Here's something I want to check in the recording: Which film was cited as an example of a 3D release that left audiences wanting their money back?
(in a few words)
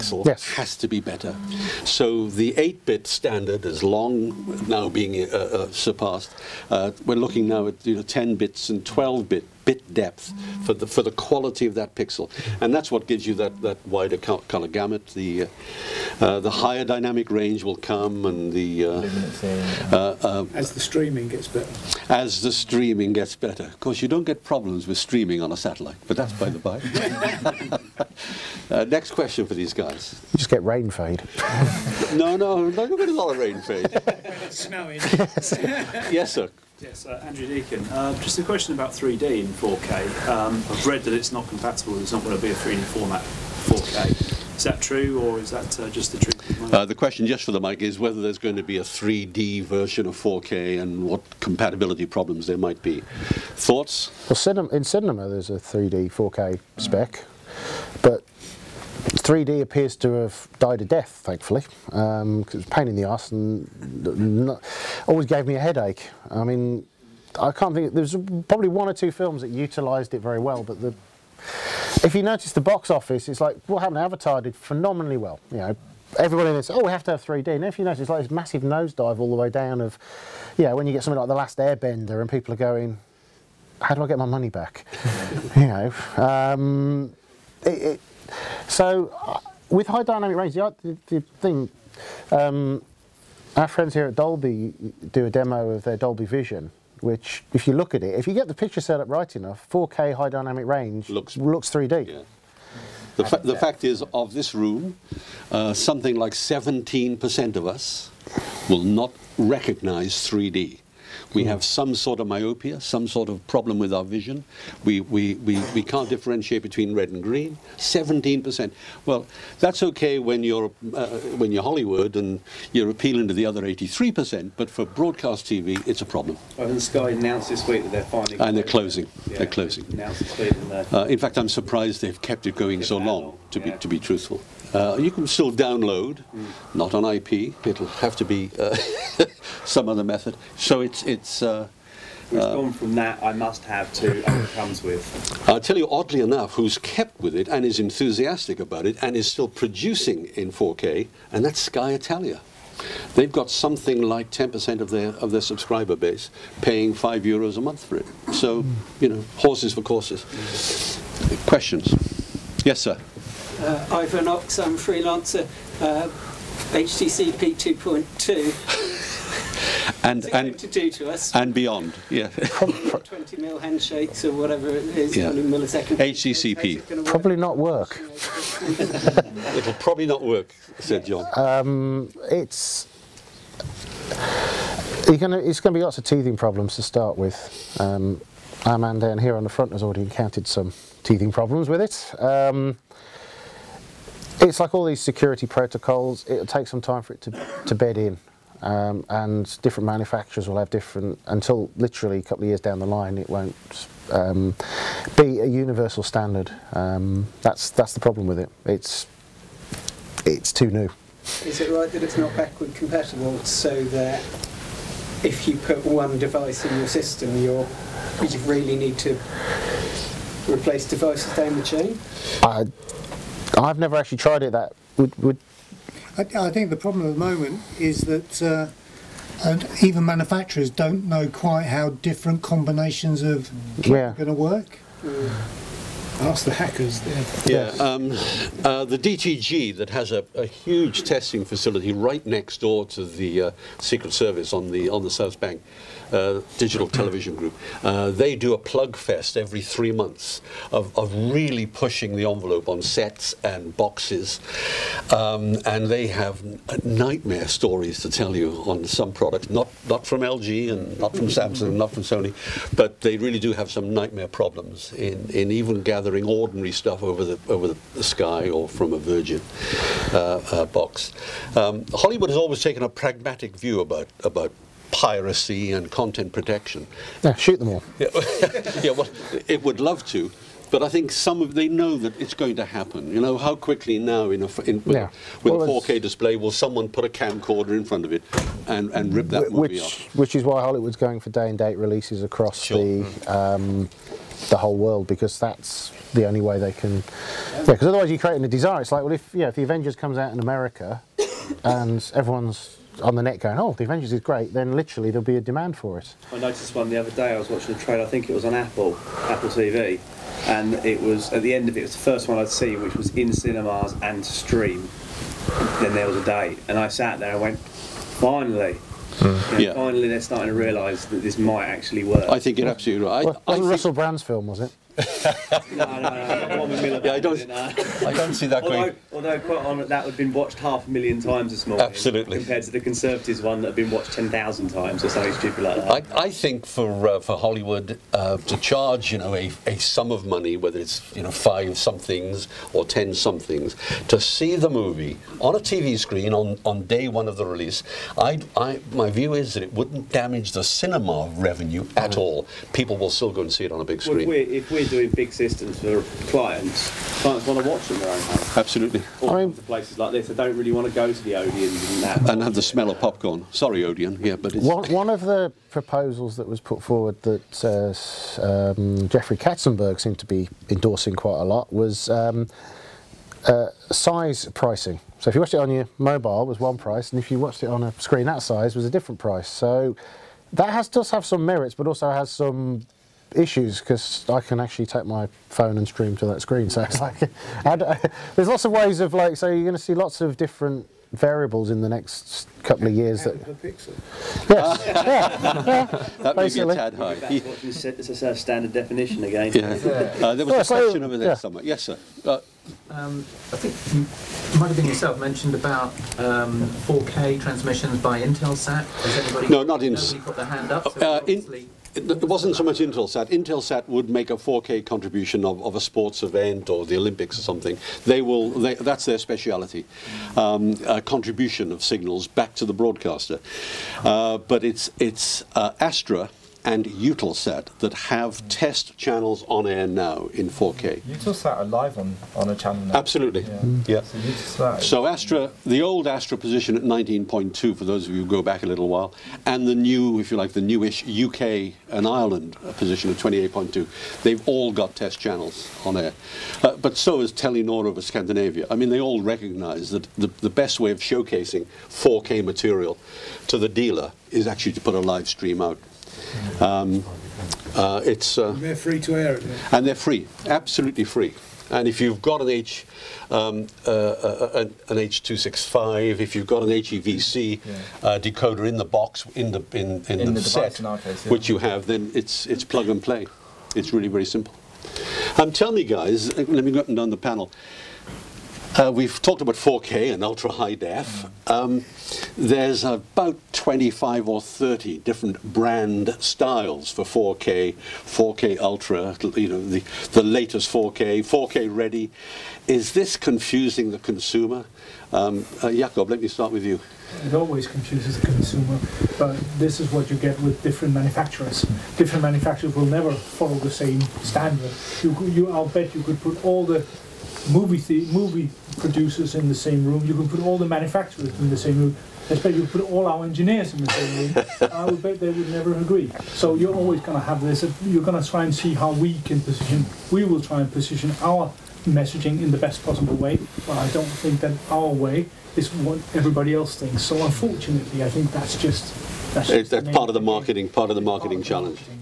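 The Last Airbender.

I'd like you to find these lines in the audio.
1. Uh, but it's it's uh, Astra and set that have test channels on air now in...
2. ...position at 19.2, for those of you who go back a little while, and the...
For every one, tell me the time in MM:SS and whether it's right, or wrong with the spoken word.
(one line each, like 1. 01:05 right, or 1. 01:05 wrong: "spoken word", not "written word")
1. 07:04 right
2. 07:16 right.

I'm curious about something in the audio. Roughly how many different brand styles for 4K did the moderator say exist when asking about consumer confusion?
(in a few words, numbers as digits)
25 or 30.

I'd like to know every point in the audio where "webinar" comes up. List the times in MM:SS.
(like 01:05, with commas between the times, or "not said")
not said.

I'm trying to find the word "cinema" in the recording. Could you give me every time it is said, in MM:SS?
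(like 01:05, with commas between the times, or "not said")
00:54, 05:13, 05:50.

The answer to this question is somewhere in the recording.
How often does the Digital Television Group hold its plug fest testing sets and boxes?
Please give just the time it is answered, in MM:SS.
04:09.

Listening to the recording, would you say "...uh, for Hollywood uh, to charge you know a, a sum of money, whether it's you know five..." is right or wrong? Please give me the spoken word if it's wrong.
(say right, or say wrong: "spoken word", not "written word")
right.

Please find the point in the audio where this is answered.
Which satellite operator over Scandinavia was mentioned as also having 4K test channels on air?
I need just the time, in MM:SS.
07:27.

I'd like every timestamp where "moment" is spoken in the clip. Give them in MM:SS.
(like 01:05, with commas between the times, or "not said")
03:47.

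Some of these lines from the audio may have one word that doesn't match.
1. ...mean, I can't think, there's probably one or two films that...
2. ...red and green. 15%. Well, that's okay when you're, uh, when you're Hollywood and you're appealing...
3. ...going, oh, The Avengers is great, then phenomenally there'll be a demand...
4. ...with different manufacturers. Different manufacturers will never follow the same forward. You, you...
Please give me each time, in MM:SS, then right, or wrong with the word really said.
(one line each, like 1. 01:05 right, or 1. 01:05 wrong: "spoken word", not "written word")
1. 01:06 right
2. 01:56 wrong: "17", not "15"
3. 05:03 wrong: "literally", not "phenomenally"
4. 08:20 wrong: "standard", not "forward".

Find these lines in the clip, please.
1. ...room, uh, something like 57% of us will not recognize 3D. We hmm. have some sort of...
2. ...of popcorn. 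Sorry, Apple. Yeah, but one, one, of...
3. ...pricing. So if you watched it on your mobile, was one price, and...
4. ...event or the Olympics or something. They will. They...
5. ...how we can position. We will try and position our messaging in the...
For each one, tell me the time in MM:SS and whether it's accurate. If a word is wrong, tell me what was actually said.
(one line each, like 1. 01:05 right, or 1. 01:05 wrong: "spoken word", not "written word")
1. 01:44 wrong: "17", not "57"
2. 06:02 wrong: "Odeon", not "Apple"
3. 06:14 right
4. 06:56 right
5. 08:38 right.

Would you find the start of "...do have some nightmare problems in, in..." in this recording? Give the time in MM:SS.
04:23.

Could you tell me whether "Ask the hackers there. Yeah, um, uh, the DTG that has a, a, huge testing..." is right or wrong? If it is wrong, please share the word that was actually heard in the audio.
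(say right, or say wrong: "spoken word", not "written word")
right.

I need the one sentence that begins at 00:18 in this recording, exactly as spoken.
Uh, uh, uh, as the streaming gets better.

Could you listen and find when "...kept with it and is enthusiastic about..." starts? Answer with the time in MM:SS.
02:26.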